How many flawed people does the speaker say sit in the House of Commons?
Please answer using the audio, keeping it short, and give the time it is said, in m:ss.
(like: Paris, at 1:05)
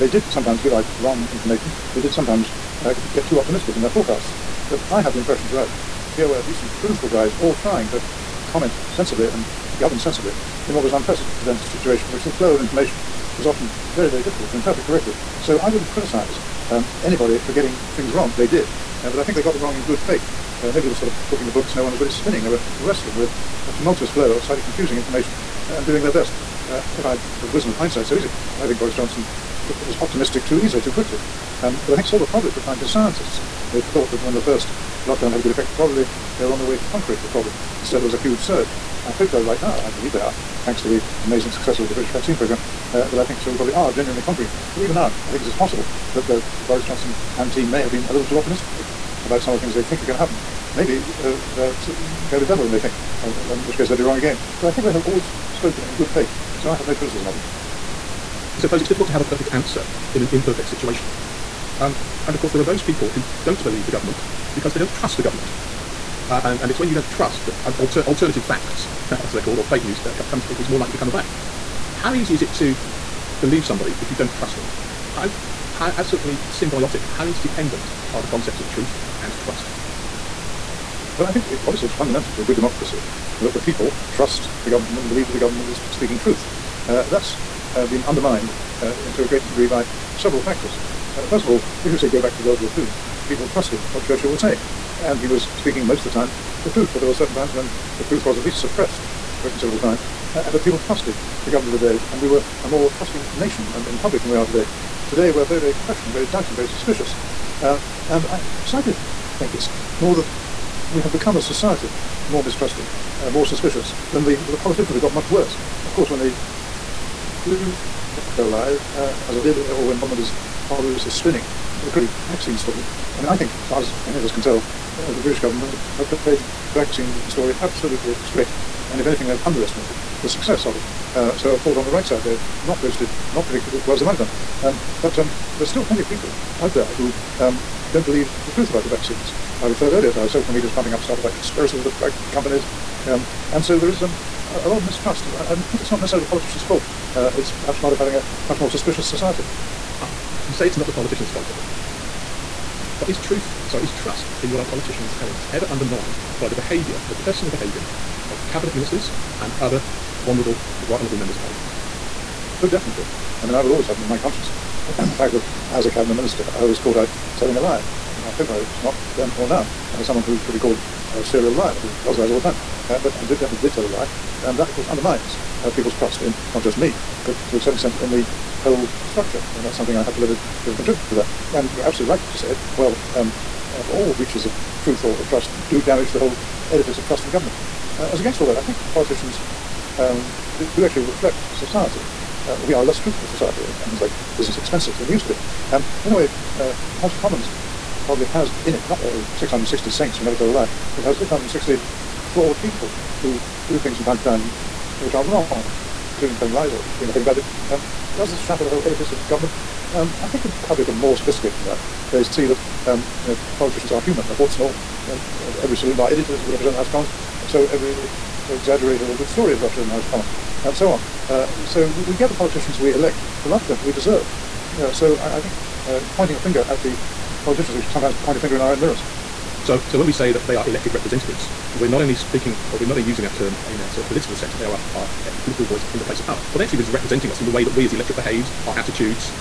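660, at 3:21.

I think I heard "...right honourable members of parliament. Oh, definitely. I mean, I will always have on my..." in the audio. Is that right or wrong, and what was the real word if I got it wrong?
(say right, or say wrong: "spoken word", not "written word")
right.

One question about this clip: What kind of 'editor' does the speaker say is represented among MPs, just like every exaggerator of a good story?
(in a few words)
saloon bar editor.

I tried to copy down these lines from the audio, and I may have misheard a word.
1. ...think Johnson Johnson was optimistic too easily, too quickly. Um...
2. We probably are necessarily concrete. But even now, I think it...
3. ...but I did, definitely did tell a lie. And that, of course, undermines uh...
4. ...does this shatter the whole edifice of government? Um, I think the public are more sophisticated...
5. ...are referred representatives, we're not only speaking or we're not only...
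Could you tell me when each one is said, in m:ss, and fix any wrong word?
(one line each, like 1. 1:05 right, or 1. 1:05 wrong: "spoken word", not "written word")
1. 0:28 wrong: "Boris", not "Johnson"
2. 0:43 wrong: "genuinely", not "necessarily"
3. 2:52 right
4. 3:28 right
5. 3:50 wrong: "elected", not "referred".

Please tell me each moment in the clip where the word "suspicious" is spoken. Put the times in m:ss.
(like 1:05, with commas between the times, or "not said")
1:46, 1:53, 2:28.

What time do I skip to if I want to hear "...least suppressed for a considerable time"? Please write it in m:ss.
1:38.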